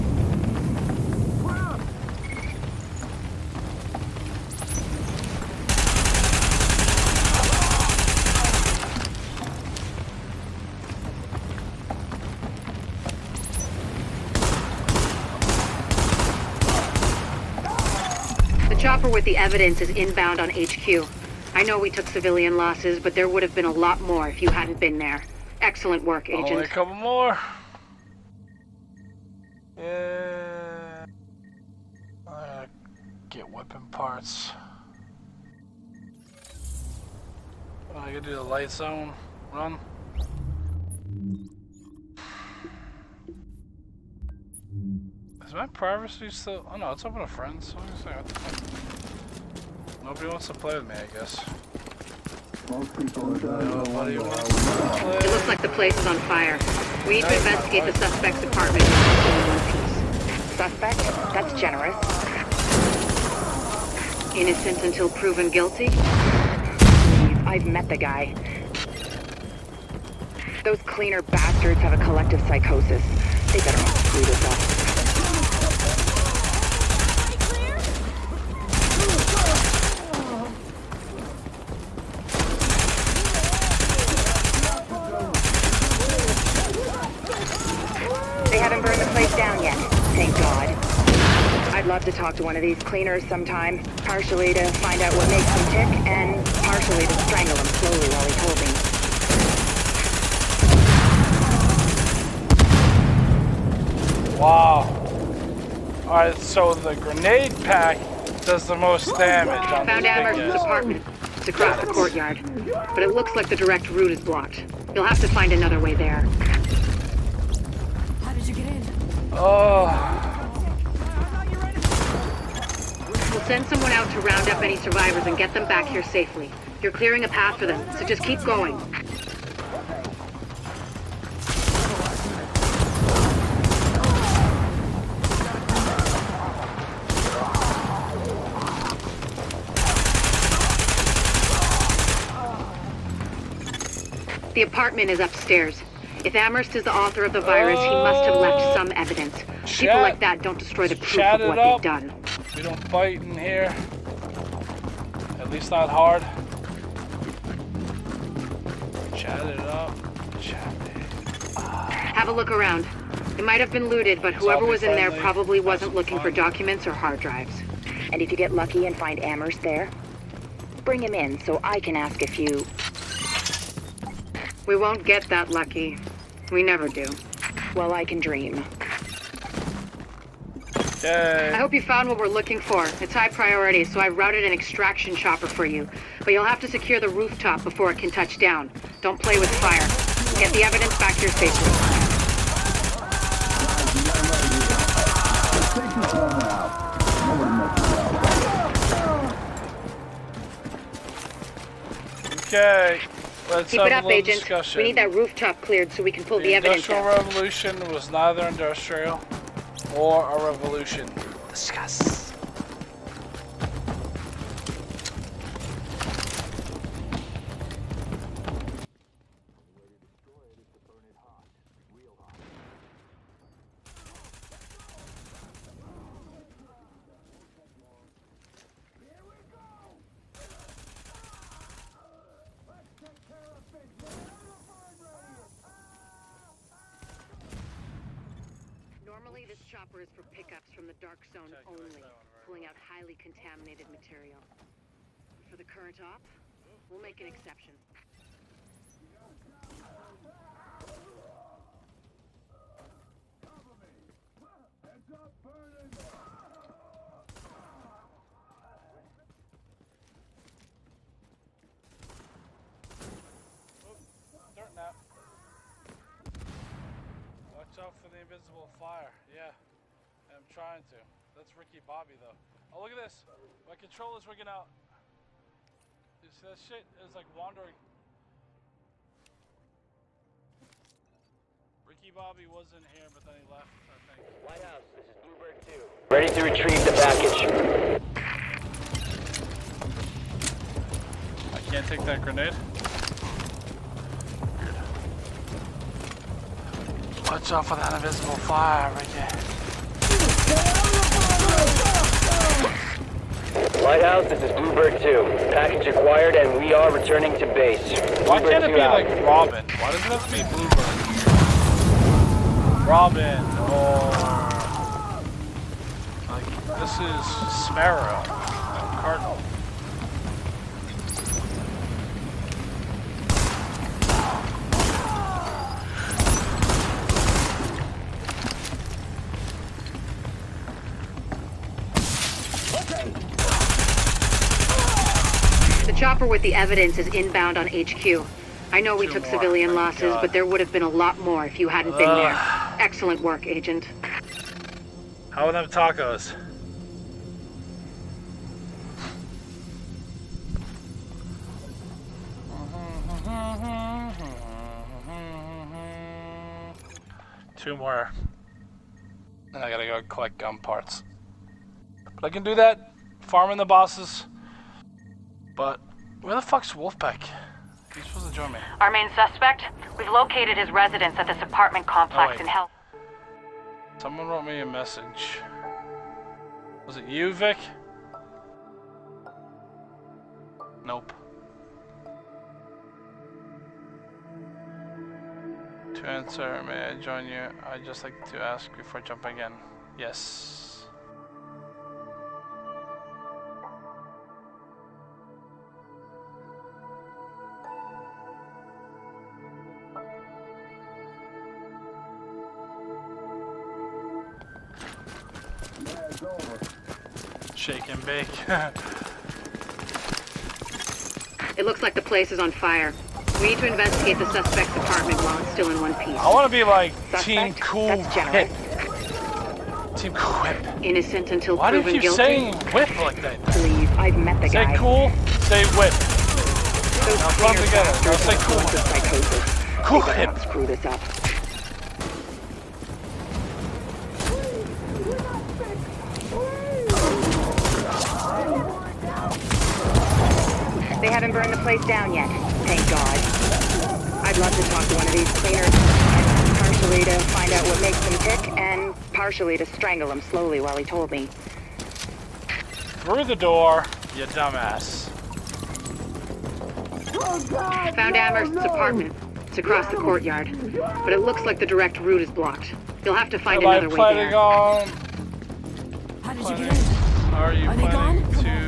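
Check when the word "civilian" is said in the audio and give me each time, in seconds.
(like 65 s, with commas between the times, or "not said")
22 s, 339 s.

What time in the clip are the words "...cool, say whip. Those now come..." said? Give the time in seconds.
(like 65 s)
424 s.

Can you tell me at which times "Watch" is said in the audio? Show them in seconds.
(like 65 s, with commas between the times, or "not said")
267 s, 297 s.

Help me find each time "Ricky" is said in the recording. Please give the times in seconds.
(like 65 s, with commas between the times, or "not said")
271 s, 281 s.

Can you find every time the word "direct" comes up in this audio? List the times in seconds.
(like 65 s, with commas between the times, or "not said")
113 s, 461 s.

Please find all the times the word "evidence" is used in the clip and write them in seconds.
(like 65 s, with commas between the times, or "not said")
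19 s, 148 s, 190 s, 206 s, 336 s.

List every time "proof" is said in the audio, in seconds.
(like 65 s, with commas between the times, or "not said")
150 s.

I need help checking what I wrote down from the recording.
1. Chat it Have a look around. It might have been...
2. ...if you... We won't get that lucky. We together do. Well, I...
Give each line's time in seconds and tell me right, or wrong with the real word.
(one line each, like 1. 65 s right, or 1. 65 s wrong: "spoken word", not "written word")
1. 160 s right
2. 172 s wrong: "never", not "together".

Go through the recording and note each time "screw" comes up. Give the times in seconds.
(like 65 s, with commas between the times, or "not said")
73 s, 430 s.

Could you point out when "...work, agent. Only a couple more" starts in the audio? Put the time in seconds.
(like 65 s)
26 s.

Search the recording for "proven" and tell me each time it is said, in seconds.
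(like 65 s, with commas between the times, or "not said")
65 s, 421 s.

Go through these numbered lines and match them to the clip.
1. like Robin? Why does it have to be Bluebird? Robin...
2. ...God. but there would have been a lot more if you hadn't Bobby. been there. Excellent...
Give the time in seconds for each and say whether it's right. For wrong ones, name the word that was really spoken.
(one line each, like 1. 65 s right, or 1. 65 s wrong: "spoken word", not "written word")
1. 308 s right
2. 340 s wrong: "Ugh", not "Bobby".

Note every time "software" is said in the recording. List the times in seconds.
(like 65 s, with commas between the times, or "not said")
not said.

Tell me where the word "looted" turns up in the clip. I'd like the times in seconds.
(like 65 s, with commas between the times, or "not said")
163 s.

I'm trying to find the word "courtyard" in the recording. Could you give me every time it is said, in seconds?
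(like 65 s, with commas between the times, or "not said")
111 s, 460 s.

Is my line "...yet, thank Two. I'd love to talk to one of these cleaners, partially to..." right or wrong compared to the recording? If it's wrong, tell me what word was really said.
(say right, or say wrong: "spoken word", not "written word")
wrong: "God", not "Two".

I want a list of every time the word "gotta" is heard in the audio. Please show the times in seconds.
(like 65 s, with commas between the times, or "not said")
38 s, 359 s.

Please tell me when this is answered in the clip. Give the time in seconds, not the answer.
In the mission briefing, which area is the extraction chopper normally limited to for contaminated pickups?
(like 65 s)
240 s.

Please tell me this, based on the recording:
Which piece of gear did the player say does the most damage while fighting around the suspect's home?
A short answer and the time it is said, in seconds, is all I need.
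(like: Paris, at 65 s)
Grenade pack, at 106 s.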